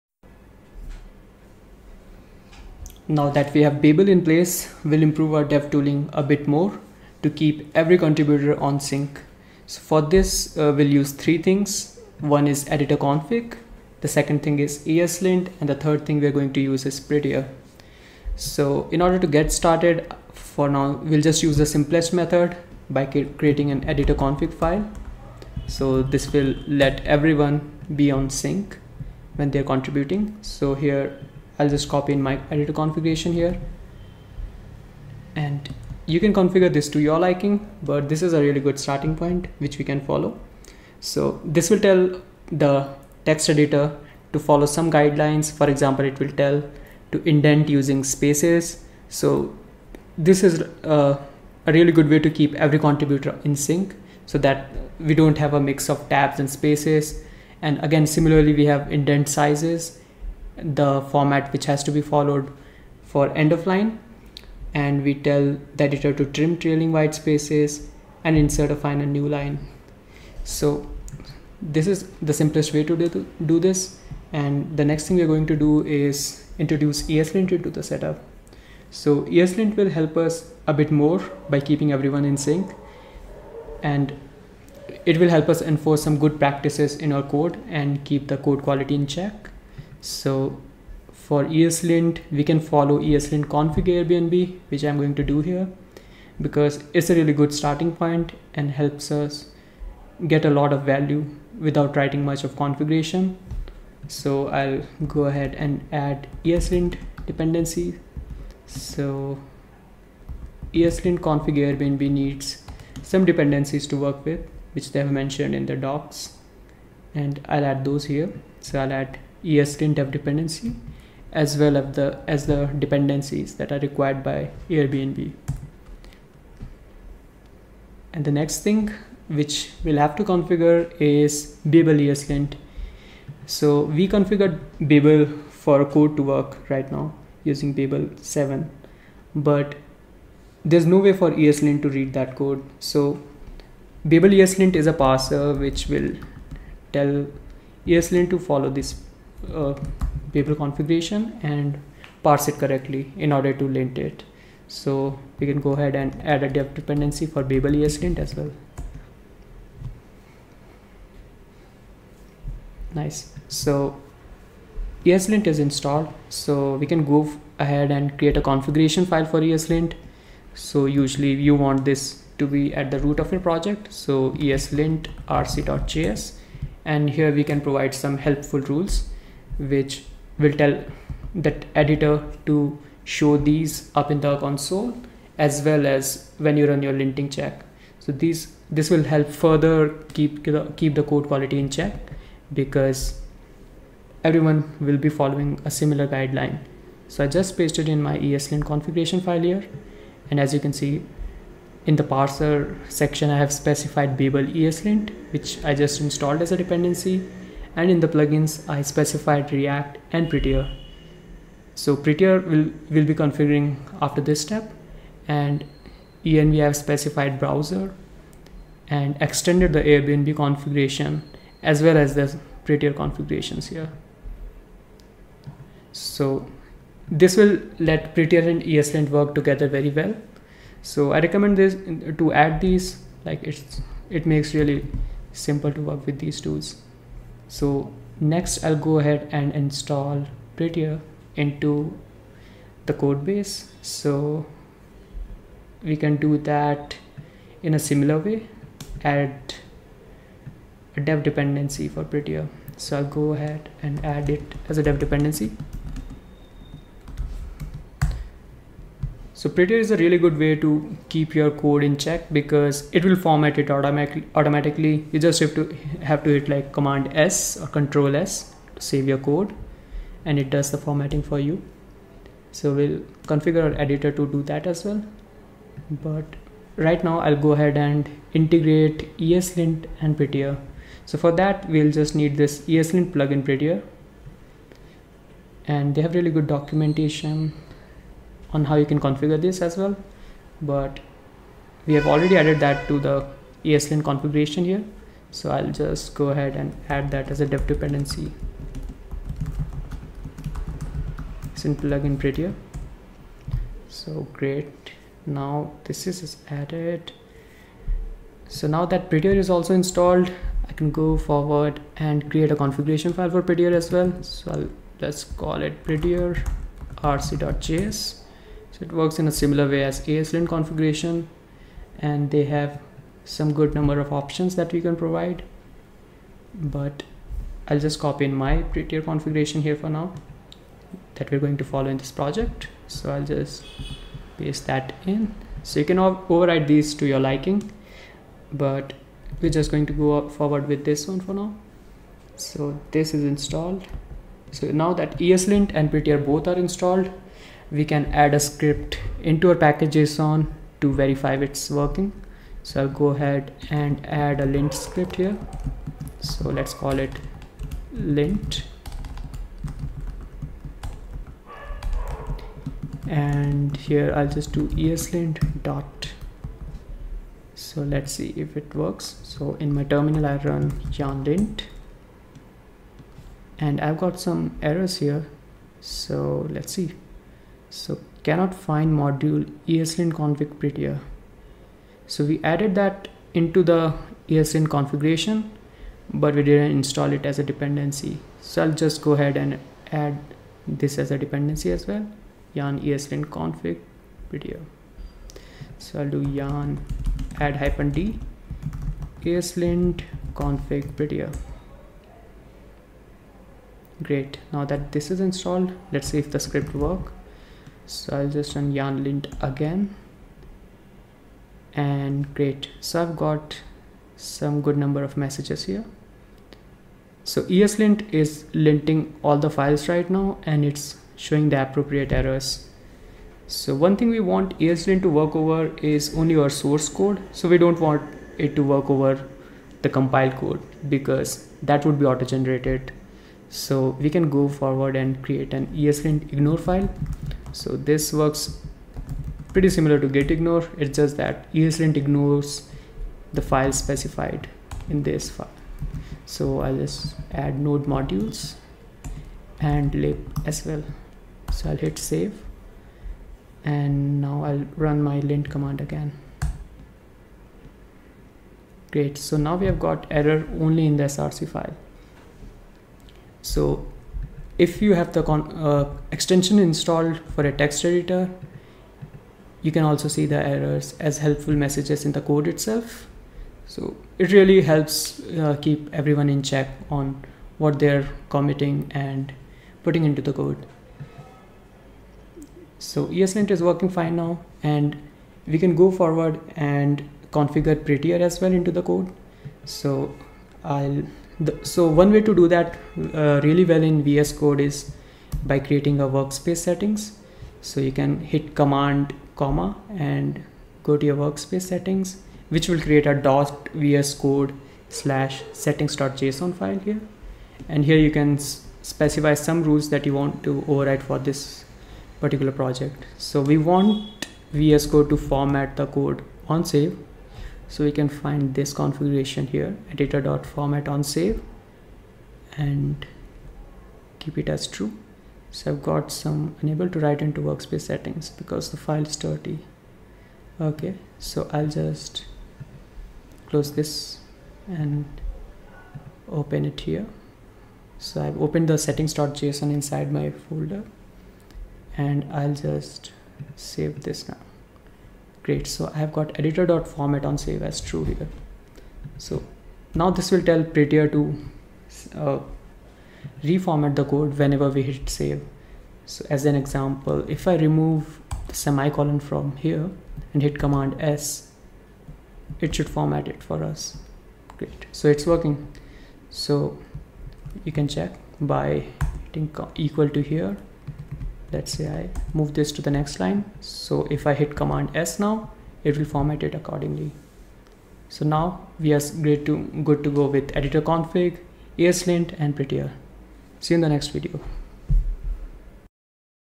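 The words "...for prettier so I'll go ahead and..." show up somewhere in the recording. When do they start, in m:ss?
4:11.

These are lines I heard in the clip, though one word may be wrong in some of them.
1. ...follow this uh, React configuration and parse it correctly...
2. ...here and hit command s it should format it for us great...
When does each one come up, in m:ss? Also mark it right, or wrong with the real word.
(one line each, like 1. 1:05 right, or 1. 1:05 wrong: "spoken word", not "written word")
1. 2:28 wrong: "Babel", not "React"
2. 9:19 right.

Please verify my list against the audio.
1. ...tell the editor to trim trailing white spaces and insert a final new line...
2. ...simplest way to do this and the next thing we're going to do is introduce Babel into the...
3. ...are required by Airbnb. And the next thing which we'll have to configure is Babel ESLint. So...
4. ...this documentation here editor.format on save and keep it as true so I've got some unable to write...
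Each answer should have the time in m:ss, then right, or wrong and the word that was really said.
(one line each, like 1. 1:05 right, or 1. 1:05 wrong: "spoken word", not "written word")
1. 1:05 right
2. 1:12 wrong: "ESLint", not "Babel"
3. 2:03 right
4. 8:38 wrong: "configuration", not "documentation".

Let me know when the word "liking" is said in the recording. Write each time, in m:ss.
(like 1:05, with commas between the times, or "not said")
0:37, 5:37.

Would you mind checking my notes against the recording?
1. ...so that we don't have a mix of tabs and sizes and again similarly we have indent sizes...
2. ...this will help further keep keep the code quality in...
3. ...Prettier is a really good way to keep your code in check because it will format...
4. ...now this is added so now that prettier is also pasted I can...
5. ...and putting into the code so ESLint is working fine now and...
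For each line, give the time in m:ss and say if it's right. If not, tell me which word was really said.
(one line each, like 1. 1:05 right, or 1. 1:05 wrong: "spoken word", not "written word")
1. 0:54 wrong: "spaces", not "sizes"
2. 3:08 right
3. 4:19 right
4. 5:05 wrong: "installed", not "pasted"
5. 7:59 right.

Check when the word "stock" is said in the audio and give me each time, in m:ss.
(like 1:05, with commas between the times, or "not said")
not said.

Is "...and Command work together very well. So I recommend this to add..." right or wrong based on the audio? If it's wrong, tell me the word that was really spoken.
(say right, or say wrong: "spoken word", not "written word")
wrong: "ESLint", not "Command".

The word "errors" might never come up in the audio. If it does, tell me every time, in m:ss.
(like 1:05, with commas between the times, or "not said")
6:14, 7:02, 7:40, 7:50.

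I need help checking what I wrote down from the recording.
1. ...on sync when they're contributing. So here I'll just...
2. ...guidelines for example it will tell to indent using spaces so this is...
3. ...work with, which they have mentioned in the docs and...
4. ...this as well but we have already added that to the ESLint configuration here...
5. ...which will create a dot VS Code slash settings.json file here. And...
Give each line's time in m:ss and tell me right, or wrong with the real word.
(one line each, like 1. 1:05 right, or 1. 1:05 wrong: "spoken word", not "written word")
1. 0:28 right
2. 0:44 right
3. 1:53 right
4. 4:49 right
5. 8:22 right.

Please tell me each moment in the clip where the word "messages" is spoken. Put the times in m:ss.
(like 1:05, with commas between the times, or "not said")
6:55, 7:51.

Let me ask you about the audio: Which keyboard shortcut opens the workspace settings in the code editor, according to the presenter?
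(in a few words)
command comma.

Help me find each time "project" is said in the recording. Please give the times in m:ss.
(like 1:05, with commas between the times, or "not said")
2:53, 5:32, 8:32.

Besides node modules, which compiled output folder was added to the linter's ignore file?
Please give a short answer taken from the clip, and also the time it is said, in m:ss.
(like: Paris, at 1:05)
lib, at 7:29.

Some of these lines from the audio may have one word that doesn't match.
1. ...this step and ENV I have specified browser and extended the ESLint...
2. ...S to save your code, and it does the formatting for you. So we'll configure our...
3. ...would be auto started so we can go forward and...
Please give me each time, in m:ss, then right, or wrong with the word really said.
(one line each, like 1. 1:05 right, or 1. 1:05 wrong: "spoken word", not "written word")
1. 3:34 wrong: "Airbnb", not "ESLint"
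2. 4:28 right
3. 7:11 wrong: "generated", not "started".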